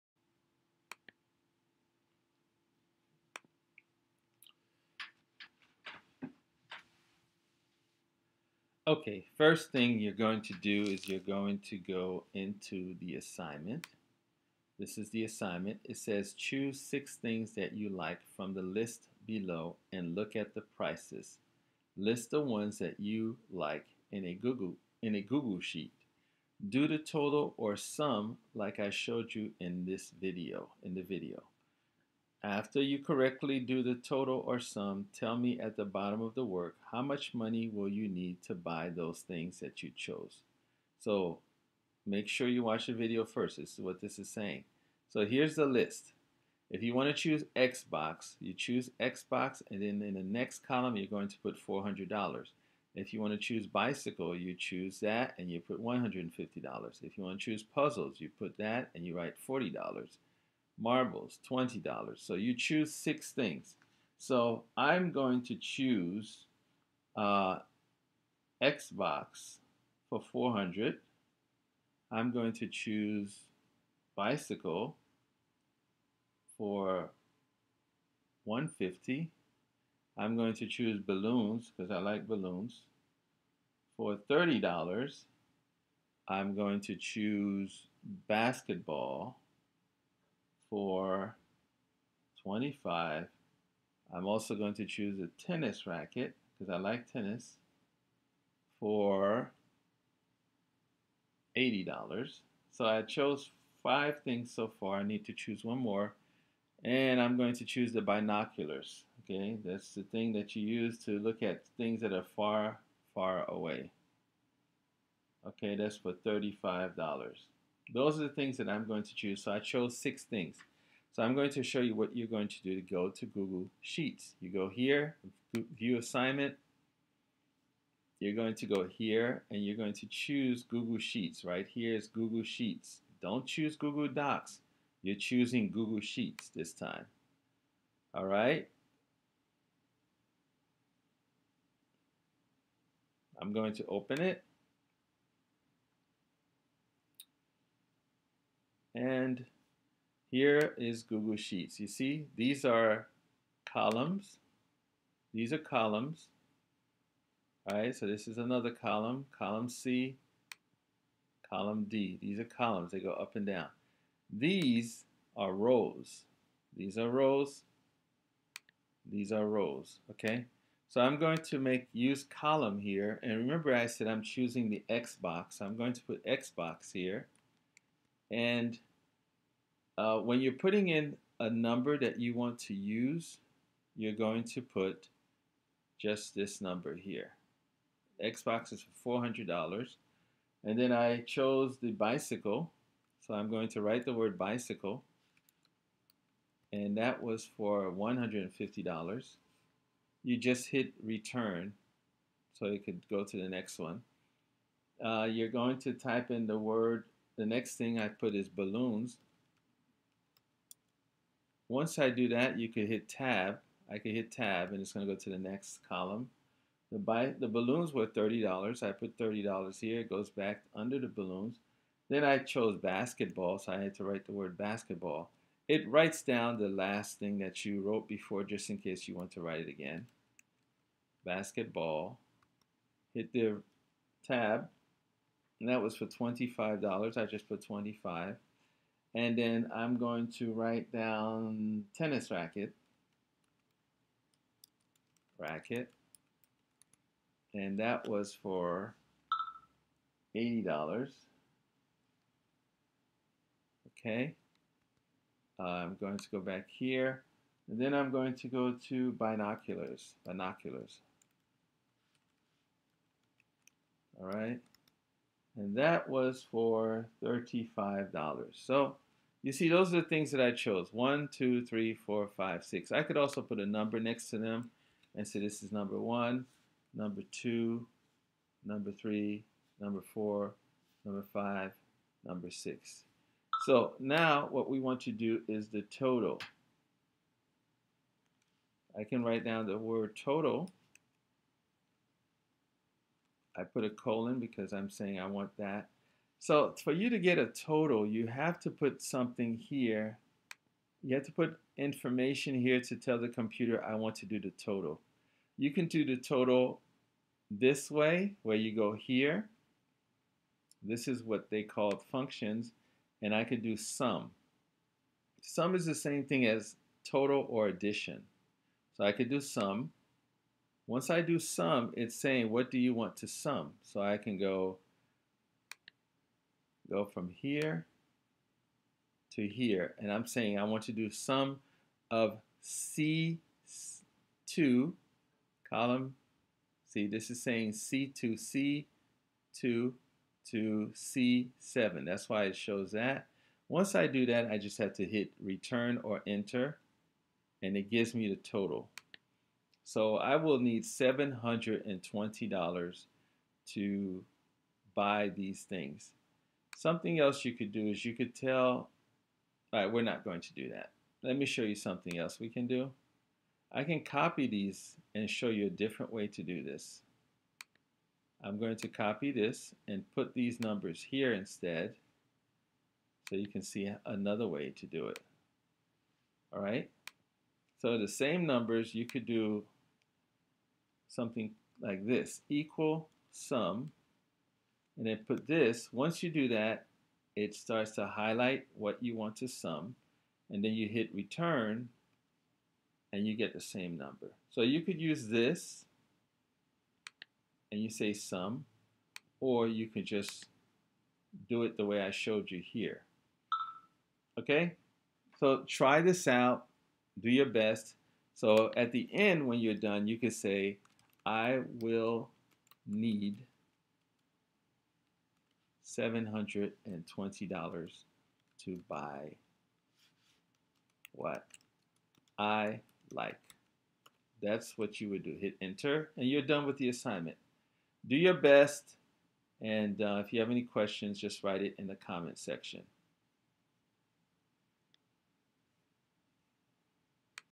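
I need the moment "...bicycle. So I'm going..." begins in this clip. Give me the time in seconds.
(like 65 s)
191 s.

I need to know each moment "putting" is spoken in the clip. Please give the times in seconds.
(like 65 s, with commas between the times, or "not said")
180 s.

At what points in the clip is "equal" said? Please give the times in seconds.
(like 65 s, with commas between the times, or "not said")
382 s.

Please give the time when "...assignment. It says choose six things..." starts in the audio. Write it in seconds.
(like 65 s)
15 s.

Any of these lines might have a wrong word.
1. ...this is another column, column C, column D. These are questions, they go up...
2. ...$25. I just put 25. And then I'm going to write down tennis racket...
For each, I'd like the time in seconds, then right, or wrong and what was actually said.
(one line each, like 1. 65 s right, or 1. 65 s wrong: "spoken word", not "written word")
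1. 158 s wrong: "columns", not "questions"
2. 236 s right.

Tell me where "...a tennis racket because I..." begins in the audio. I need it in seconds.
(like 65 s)
95 s.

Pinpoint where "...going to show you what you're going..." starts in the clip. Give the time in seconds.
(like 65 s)
121 s.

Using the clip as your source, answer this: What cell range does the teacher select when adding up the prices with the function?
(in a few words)
C2 to C7.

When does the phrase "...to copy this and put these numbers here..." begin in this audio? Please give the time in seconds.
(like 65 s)
368 s.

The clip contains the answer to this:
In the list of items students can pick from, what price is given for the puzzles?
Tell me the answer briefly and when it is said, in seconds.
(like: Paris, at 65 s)
$40, at 59 s.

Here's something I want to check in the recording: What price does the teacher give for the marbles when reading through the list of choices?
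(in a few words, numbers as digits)
$20.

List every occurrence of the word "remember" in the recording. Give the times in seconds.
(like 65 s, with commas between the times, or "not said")
173 s.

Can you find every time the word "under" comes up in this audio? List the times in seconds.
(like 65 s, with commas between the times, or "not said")
220 s.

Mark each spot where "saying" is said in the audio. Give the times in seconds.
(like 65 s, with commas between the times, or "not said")
44 s, 294 s, 322 s, 330 s, 337 s.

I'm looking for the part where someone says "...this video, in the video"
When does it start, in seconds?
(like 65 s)
29 s.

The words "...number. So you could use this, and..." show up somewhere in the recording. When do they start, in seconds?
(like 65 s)
393 s.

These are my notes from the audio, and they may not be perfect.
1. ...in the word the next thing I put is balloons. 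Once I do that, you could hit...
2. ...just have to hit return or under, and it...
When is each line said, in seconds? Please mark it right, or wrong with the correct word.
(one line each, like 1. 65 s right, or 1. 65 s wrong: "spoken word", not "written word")
1. 206 s right
2. 344 s wrong: "enter", not "under".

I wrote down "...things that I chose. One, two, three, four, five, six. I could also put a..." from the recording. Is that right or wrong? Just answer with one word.
right.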